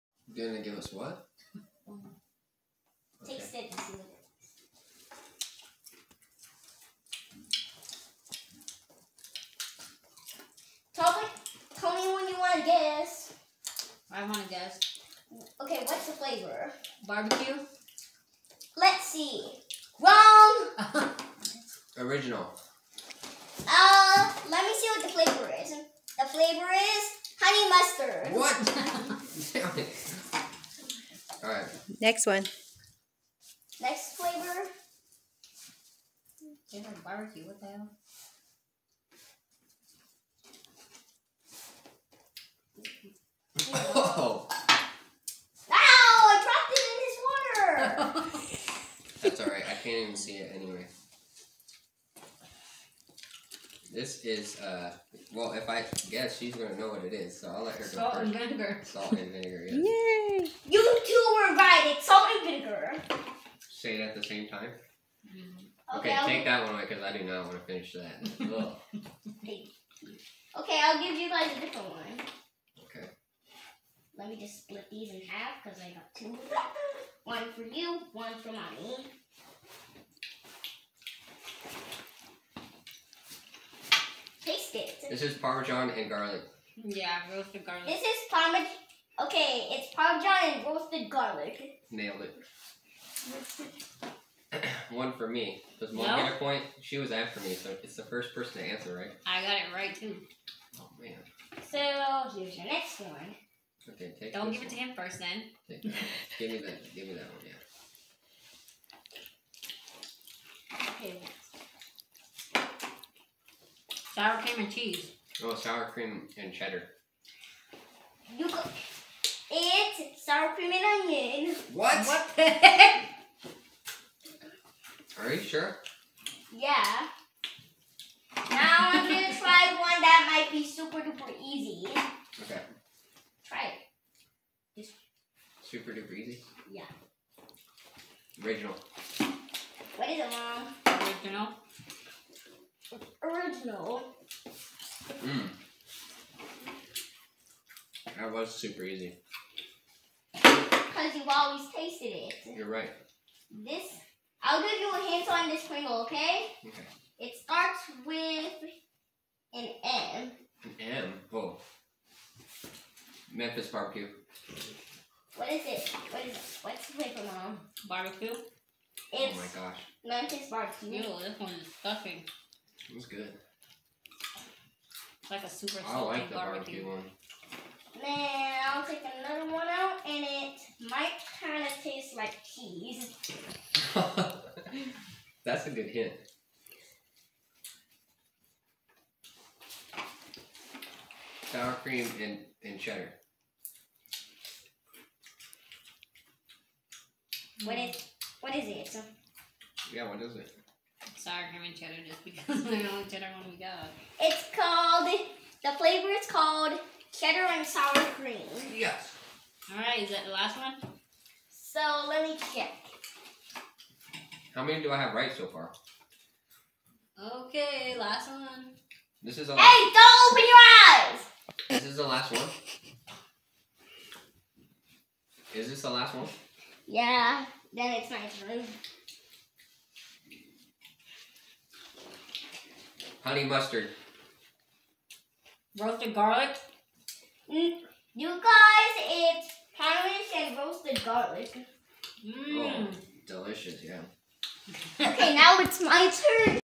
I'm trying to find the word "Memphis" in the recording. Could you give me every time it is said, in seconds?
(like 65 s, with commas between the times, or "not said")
163 s, 170 s.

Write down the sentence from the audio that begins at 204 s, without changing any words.
It's called, the flavor is called cheddar and sour cream.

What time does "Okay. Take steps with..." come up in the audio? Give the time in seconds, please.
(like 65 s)
1 s.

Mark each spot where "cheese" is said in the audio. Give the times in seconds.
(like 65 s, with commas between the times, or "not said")
114 s, 182 s.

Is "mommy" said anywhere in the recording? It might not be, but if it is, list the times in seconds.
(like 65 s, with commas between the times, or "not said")
78 s.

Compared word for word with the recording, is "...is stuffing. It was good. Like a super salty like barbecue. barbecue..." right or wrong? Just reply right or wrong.
right.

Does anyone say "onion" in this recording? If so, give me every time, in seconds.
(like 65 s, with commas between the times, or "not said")
121 s.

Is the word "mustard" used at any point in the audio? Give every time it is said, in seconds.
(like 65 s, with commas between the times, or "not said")
28 s, 233 s.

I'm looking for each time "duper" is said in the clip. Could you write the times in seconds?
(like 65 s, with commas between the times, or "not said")
130 s, 135 s.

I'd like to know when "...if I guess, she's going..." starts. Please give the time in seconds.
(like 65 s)
55 s.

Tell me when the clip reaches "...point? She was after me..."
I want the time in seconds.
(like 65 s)
96 s.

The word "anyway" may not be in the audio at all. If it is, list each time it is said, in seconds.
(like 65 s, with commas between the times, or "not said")
50 s.